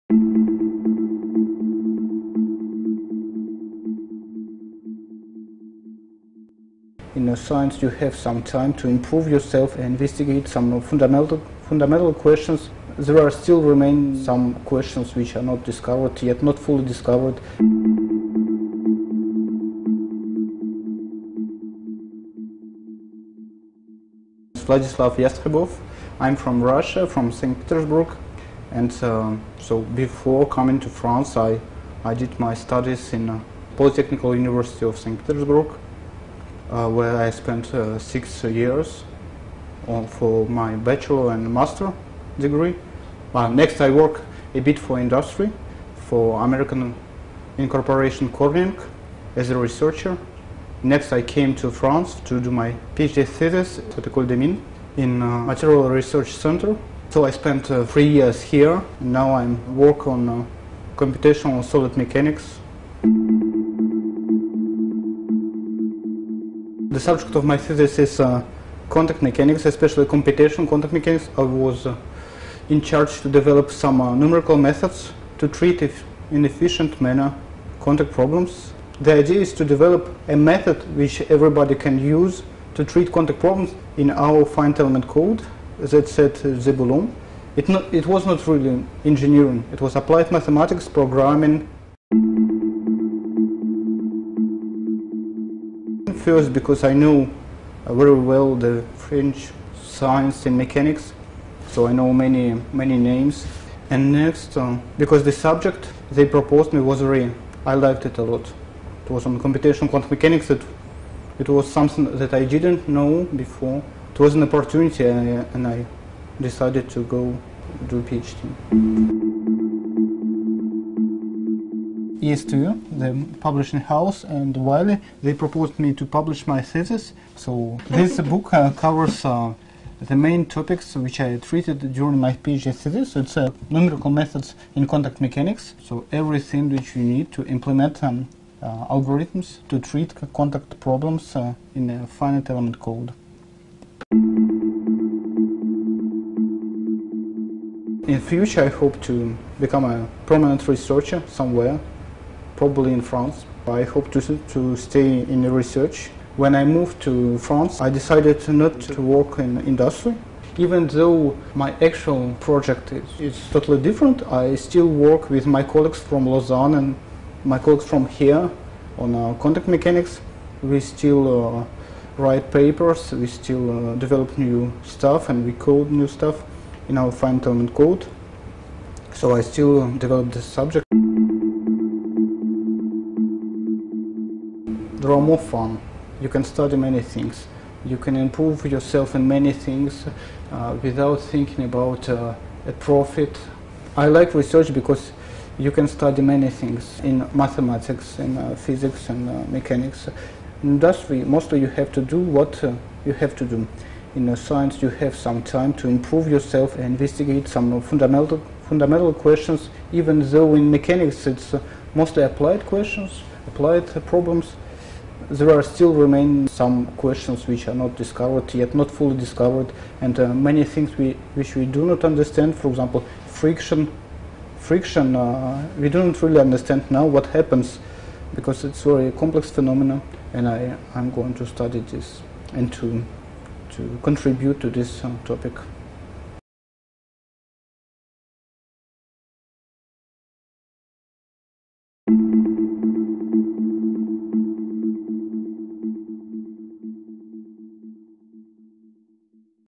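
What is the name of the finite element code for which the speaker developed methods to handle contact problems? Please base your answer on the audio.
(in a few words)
Zebulon.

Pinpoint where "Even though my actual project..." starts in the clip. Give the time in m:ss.
2:40.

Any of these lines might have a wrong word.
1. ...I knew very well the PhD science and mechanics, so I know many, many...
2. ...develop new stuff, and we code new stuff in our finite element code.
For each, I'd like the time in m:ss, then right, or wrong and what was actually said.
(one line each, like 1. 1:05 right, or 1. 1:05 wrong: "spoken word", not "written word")
1. 1:36 wrong: "French", not "PhD"
2. 2:53 right.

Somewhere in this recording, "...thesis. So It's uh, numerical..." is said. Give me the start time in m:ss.
2:12.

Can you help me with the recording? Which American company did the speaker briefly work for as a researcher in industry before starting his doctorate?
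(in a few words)
Corning.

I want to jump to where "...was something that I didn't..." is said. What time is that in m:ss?
1:51.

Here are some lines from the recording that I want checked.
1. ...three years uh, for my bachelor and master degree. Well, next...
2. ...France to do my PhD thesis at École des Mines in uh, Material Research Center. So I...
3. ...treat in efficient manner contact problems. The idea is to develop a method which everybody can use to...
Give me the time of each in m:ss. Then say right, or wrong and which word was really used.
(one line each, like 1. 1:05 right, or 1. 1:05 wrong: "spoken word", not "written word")
1. 0:37 wrong: "six", not "three"
2. 0:51 right
3. 1:15 right.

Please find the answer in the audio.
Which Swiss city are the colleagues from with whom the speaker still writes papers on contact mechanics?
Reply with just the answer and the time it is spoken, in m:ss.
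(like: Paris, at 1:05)
Lausanne, at 2:46.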